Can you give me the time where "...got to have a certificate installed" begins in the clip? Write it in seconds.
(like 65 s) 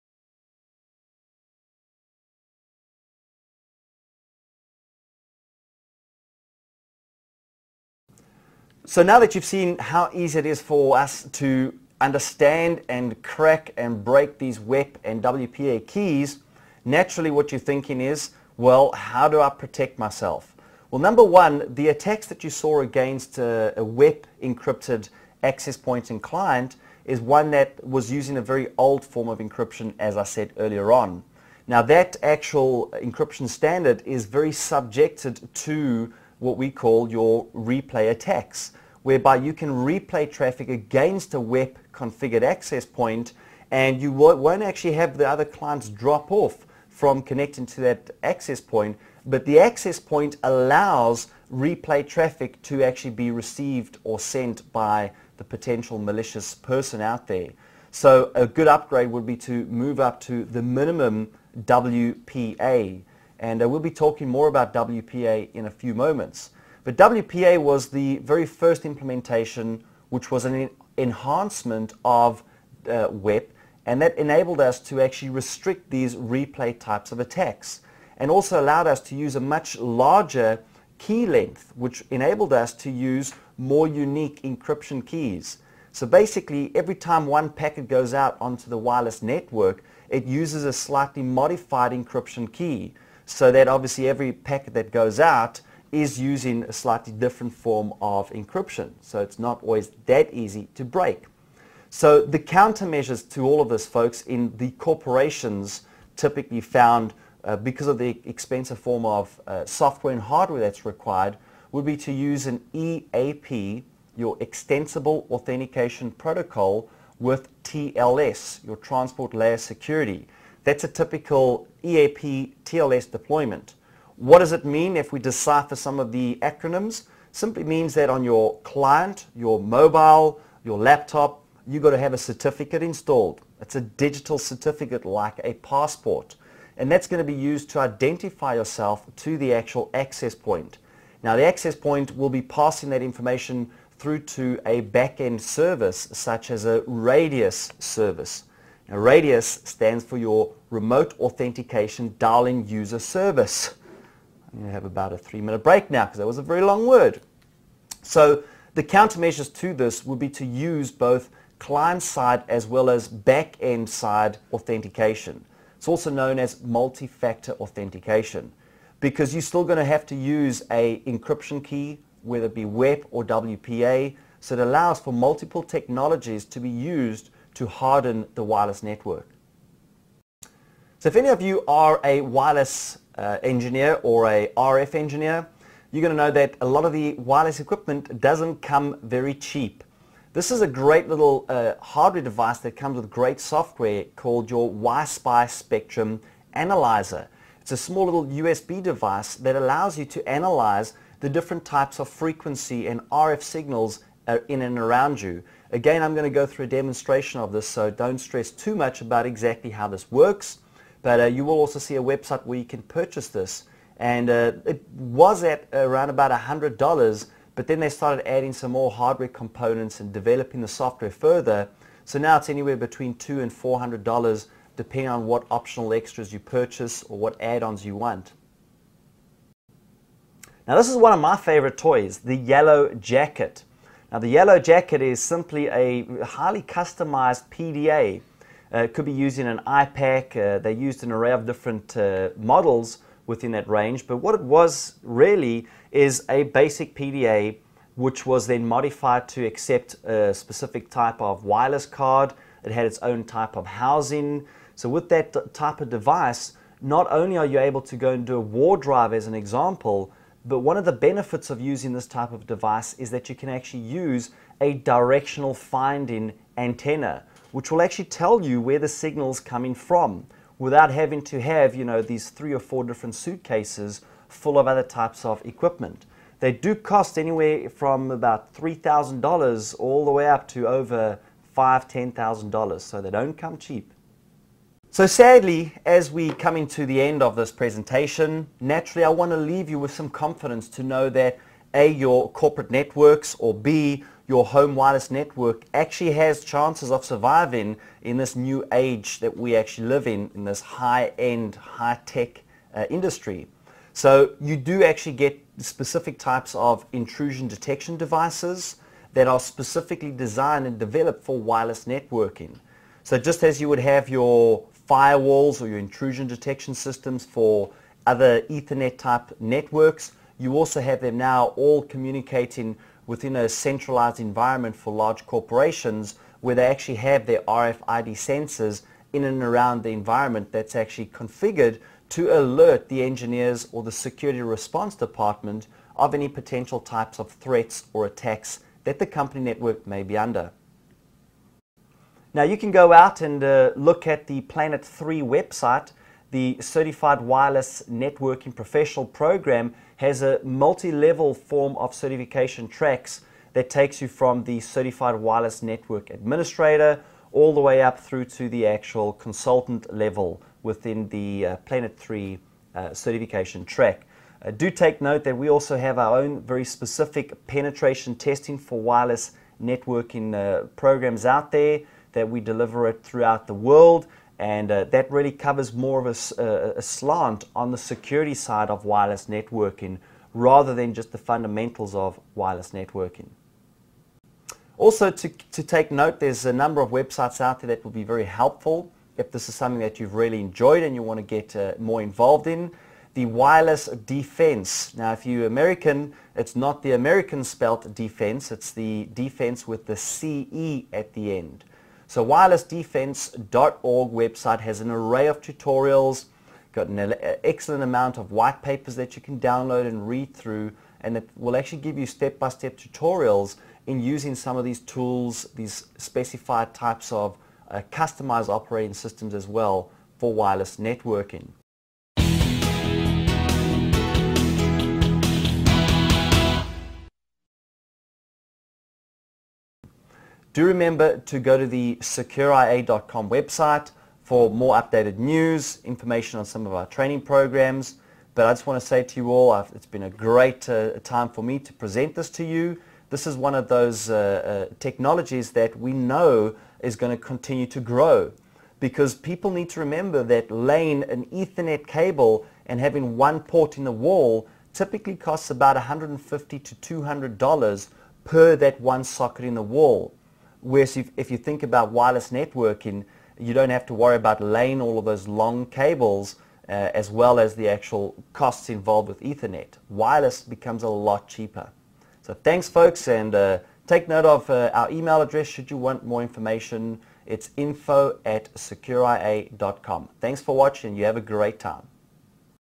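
131 s.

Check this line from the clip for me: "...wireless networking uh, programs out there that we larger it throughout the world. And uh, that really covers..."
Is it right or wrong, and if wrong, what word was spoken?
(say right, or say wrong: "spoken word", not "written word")
wrong: "deliver", not "larger".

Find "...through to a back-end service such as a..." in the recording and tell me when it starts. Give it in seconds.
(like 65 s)
143 s.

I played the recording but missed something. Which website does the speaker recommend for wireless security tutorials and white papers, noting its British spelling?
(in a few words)
wirelessdefence.org.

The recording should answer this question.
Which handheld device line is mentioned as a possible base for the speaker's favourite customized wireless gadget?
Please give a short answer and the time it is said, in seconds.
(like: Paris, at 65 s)
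iPAQ, at 239 s.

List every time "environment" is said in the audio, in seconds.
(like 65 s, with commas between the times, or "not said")
324 s, 329 s.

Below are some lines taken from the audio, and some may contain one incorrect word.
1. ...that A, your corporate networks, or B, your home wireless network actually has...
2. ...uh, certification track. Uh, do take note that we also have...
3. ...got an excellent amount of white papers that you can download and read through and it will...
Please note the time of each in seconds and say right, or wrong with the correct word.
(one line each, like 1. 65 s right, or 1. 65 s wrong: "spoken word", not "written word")
1. 291 s right
2. 362 s right
3. 406 s right.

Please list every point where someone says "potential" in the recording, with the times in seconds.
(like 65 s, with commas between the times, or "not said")
55 s, 336 s.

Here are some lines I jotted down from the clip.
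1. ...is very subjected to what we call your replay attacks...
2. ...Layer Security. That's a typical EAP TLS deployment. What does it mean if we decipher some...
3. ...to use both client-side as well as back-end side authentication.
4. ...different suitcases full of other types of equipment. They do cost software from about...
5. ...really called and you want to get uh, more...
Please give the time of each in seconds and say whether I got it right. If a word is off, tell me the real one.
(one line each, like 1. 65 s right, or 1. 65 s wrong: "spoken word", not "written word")
1. 34 s right
2. 119 s right
3. 160 s right
4. 272 s wrong: "anywhere", not "software"
5. 390 s wrong: "enjoyed", not "called".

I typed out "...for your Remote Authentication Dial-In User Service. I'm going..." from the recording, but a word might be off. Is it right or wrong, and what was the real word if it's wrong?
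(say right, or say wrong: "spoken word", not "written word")
right.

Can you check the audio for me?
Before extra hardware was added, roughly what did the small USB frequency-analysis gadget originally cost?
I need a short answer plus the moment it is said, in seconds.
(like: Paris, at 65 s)
$100, at 216 s.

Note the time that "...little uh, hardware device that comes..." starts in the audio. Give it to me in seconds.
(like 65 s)
191 s.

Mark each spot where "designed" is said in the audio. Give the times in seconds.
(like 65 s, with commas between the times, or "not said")
310 s.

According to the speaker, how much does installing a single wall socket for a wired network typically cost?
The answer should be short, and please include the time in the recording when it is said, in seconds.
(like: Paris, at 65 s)
$150 to $200, at 455 s.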